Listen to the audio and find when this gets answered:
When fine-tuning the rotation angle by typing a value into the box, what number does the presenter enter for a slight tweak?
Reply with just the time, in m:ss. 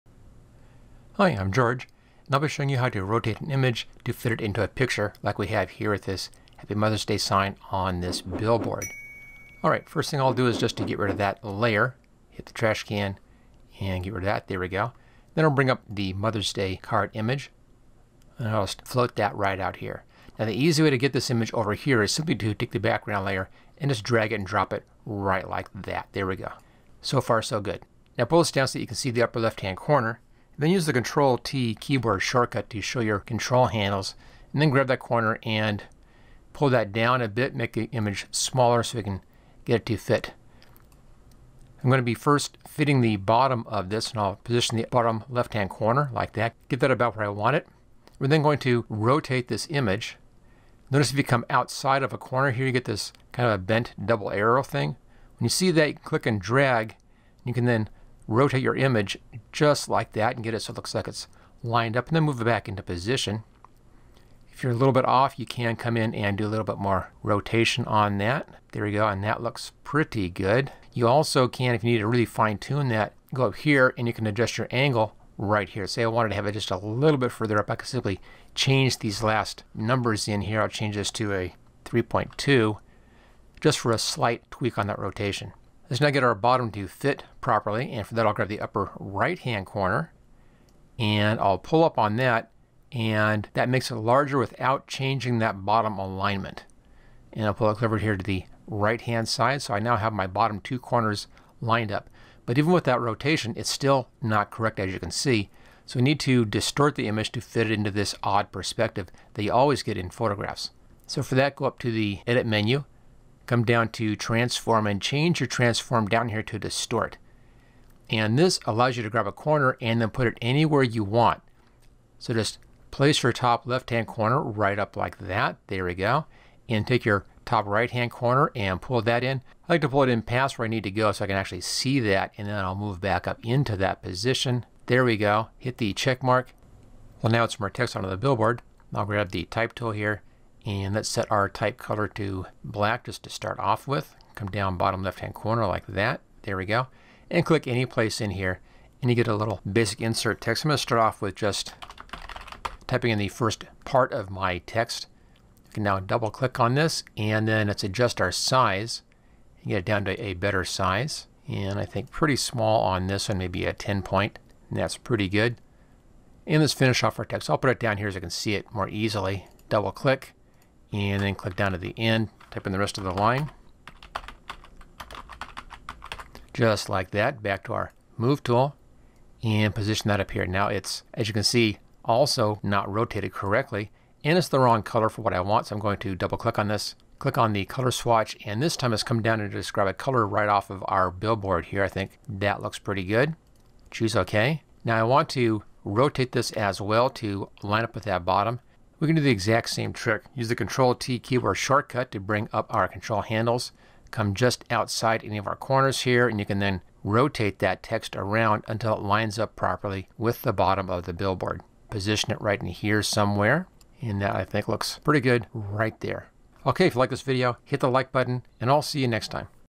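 1:21.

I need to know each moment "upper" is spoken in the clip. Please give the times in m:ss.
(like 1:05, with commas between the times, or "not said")
0:29, 1:28.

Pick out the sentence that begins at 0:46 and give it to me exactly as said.
Get that about where I want it.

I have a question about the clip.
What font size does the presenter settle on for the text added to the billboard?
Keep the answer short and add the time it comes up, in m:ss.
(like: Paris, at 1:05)
10 point, at 2:43.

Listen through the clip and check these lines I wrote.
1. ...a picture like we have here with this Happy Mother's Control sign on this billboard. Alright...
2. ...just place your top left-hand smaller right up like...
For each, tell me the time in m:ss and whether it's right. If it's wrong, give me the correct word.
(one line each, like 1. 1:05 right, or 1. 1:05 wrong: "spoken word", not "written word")
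1. 0:04 wrong: "Day", not "Control"
2. 2:02 wrong: "corner", not "smaller".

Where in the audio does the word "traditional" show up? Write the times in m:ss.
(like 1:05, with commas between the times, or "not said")
not said.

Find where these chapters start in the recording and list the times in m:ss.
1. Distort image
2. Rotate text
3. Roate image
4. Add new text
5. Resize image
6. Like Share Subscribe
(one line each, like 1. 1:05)
1. 1:45
2. 3:20
3. 0:47
4. 2:16
5. 0:30
6. 3:30.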